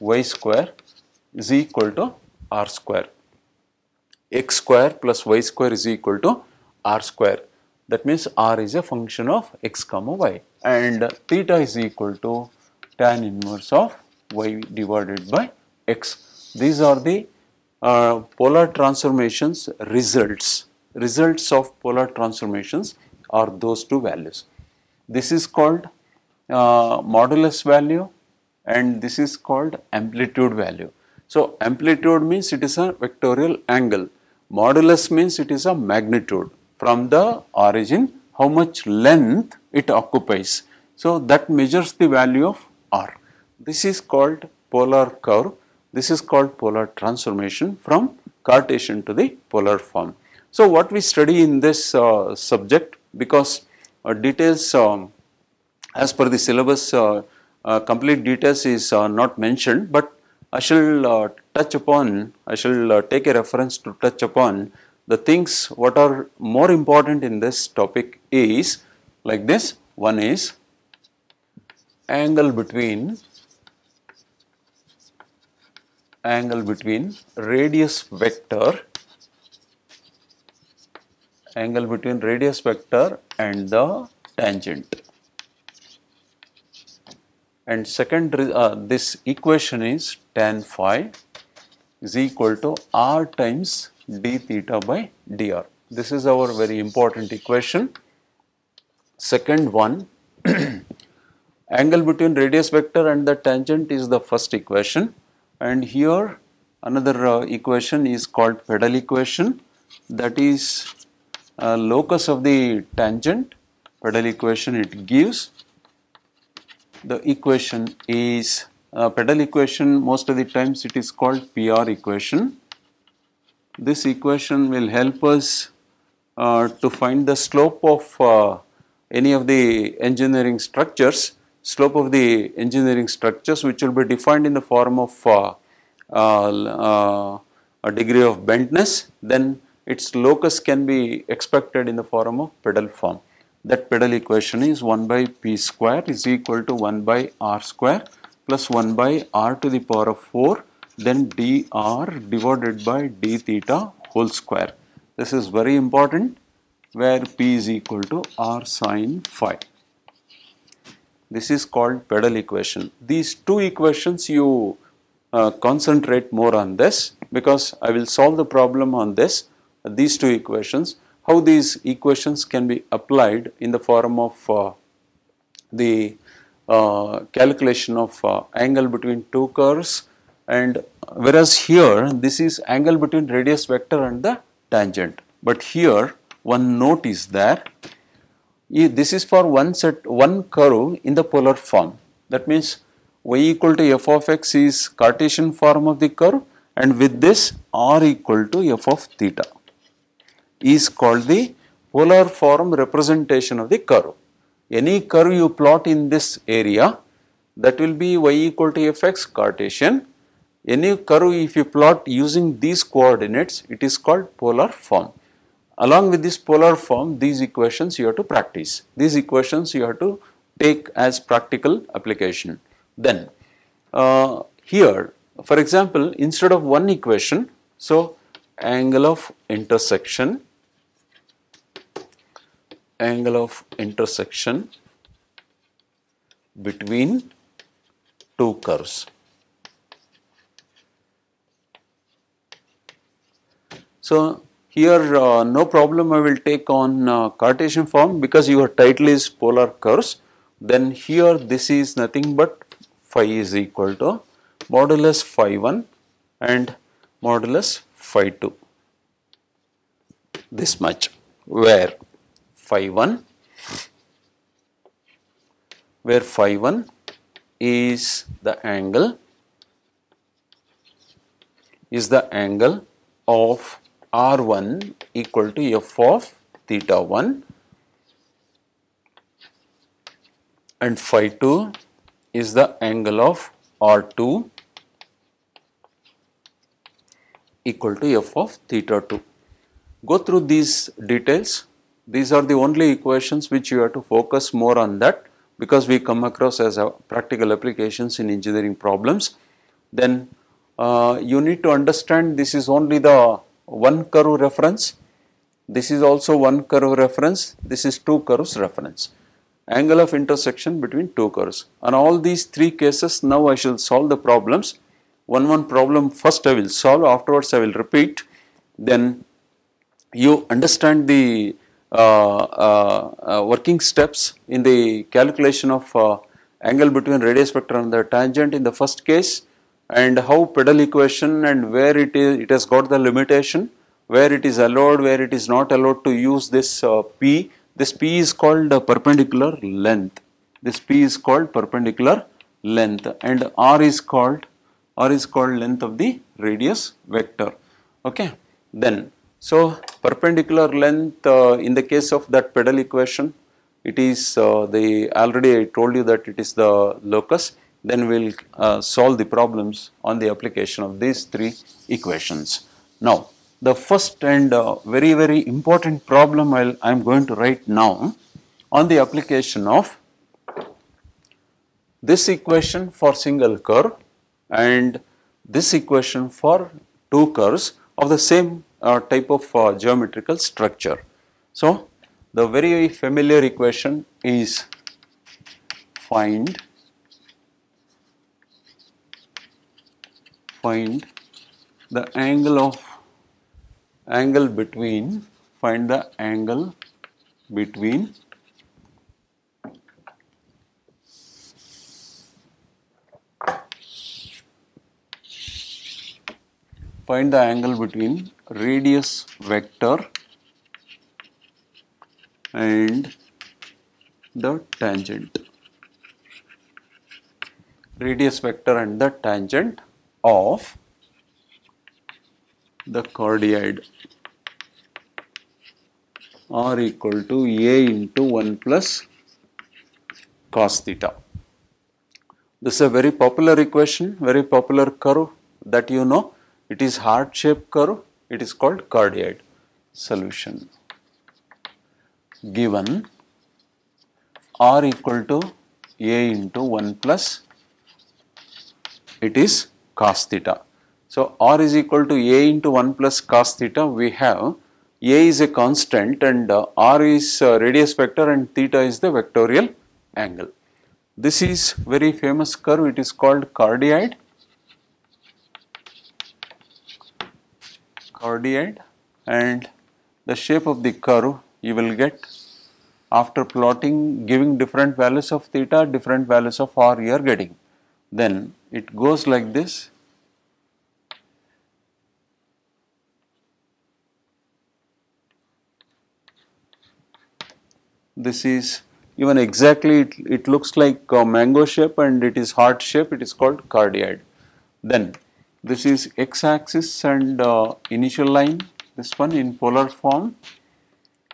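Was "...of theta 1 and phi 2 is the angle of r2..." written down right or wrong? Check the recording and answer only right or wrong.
right.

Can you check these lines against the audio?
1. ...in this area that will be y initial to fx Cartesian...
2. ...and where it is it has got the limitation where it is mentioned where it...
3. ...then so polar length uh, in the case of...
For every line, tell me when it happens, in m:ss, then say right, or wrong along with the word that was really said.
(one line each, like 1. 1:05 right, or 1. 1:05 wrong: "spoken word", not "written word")
1. 3:25 wrong: "equal", not "initial"
2. 5:31 wrong: "allowed", not "mentioned"
3. 5:48 wrong: "perpendicular", not "polar".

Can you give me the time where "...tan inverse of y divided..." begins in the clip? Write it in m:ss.
0:13.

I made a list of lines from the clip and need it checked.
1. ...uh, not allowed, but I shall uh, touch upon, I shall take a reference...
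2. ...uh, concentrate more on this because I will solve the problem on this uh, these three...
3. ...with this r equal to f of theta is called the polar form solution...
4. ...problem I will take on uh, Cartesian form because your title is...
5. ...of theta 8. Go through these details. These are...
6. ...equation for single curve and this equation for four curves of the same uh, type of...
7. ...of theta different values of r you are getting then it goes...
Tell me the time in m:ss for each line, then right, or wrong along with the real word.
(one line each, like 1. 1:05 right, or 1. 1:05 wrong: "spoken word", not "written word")
1. 0:58 wrong: "mentioned", not "allowed"
2. 2:45 wrong: "two", not "three"
3. 3:17 wrong: "representation", not "solution"
4. 4:05 right
5. 4:48 wrong: "2", not "8"
6. 6:12 wrong: "two", not "four"
7. 7:55 right.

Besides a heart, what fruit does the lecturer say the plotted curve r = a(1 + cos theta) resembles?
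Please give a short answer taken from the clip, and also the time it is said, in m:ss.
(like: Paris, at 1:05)
mango, at 8:11.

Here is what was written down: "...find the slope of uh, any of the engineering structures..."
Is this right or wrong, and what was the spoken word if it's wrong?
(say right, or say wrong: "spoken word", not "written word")
right.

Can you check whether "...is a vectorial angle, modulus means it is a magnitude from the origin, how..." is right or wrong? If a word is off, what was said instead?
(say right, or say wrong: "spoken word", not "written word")
right.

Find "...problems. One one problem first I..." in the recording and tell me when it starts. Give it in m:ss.
5:14.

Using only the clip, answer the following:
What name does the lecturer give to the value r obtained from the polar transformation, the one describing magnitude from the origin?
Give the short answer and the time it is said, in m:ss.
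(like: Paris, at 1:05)
modulus value, at 0:27.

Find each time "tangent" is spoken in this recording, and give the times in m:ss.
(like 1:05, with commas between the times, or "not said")
1:24, 1:43, 1:52, 3:04, 5:28, 6:54, 6:59.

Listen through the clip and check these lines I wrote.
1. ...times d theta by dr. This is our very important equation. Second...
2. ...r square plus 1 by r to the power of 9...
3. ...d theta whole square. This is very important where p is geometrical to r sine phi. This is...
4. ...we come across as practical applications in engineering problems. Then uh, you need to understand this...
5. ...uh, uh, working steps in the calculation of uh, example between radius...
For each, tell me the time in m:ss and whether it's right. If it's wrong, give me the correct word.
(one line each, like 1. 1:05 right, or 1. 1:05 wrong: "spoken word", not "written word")
1. 1:33 right
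2. 2:27 wrong: "4", not "9"
3. 2:33 wrong: "equal", not "geometrical"
4. 4:55 right
5. 5:22 wrong: "angle", not "example".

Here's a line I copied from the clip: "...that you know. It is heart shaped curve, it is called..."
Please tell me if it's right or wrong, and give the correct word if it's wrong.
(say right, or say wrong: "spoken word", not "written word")
right.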